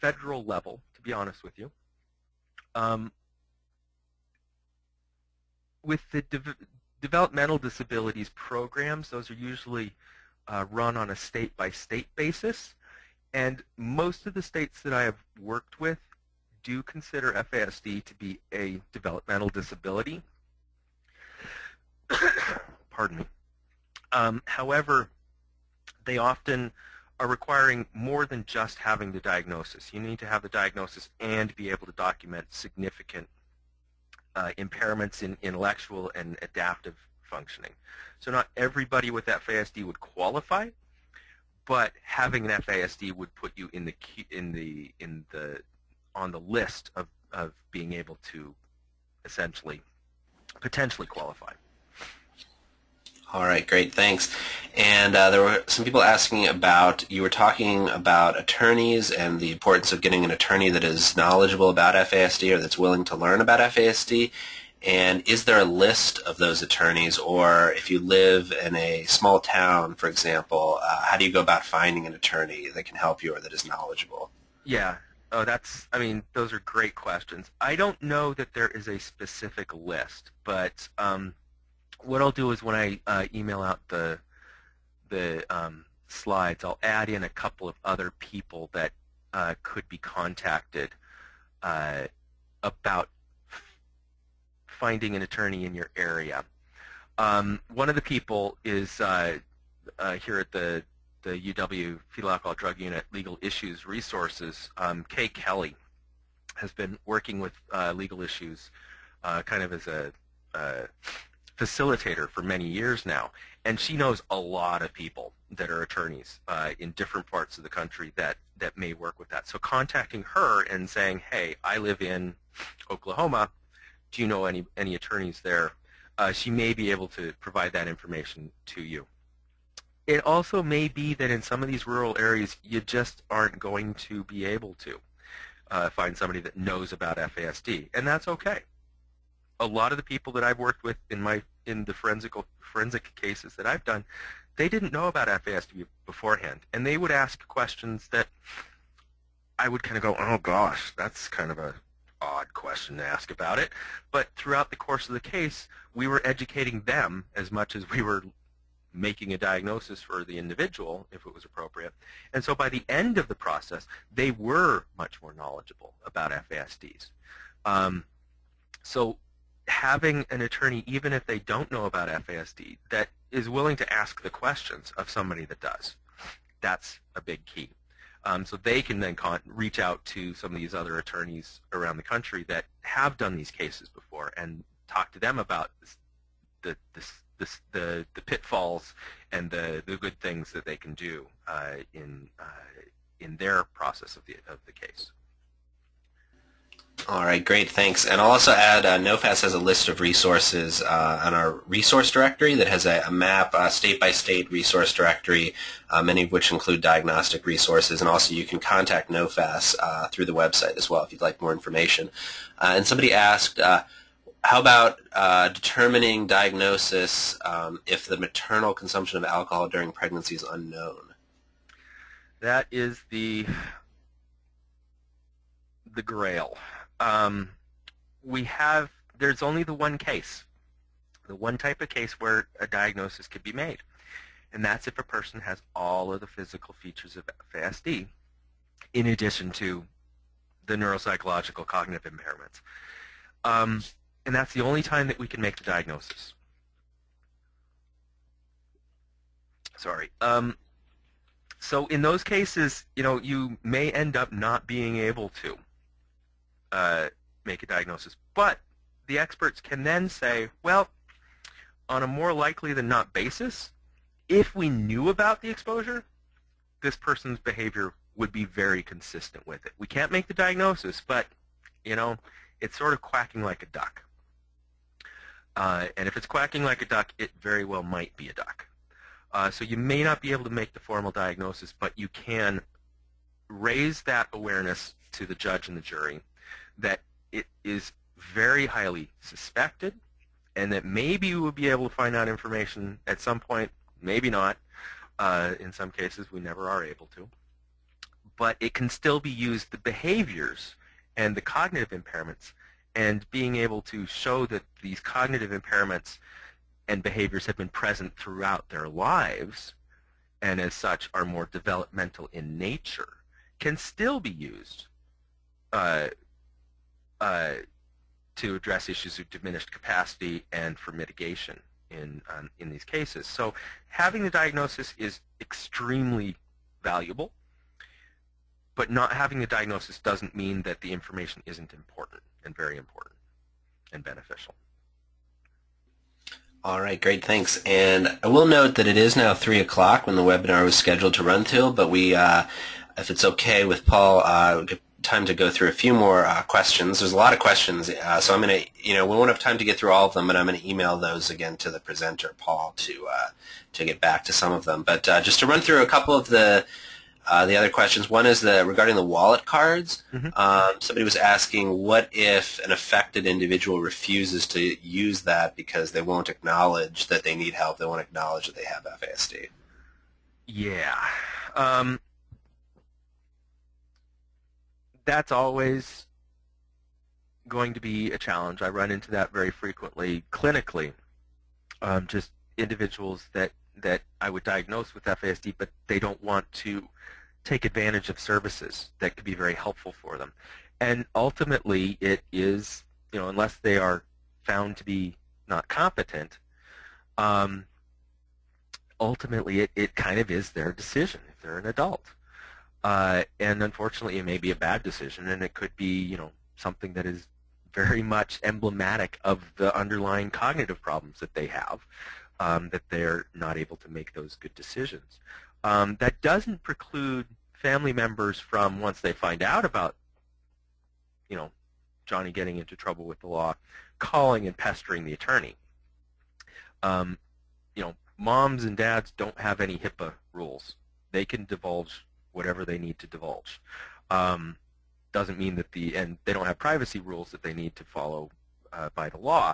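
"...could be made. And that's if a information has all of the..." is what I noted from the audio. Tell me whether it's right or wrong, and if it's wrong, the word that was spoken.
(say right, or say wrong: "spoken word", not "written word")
wrong: "person", not "information".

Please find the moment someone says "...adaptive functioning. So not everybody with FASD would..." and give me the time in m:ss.
0:36.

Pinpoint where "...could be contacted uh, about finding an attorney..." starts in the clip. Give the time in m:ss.
1:29.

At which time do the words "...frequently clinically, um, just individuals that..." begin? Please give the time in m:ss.
6:19.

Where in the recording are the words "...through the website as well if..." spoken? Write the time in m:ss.
3:30.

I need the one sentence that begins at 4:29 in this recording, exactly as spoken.
We can't make the diagnosis, but you know, it's sort of quacking like a duck.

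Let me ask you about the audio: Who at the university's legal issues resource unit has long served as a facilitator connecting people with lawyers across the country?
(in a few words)
Kay Kelly.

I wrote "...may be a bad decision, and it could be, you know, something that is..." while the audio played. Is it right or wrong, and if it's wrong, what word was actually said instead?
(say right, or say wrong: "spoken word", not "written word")
right.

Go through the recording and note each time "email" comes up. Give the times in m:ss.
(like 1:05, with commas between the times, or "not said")
1:23, 5:50.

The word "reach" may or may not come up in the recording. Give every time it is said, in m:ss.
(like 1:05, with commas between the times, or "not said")
2:59.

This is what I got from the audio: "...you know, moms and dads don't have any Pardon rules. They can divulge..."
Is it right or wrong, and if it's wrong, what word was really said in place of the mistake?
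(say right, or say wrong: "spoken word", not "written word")
wrong: "HIPAA", not "Pardon".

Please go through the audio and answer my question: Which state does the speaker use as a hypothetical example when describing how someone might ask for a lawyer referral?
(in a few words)
Oklahoma.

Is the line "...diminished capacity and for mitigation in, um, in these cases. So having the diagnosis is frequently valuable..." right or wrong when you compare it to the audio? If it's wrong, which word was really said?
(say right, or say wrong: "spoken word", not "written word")
wrong: "extremely", not "frequently".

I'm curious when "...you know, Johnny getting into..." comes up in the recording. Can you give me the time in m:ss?
7:01.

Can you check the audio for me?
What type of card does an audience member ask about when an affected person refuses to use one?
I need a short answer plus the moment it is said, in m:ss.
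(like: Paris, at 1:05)
wallet cards, at 5:59.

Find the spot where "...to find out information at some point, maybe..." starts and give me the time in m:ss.
4:51.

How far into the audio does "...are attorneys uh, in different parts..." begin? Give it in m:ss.
1:55.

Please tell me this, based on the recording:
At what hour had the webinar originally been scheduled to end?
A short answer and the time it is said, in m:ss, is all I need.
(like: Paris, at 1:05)
3 o'clock, at 5:39.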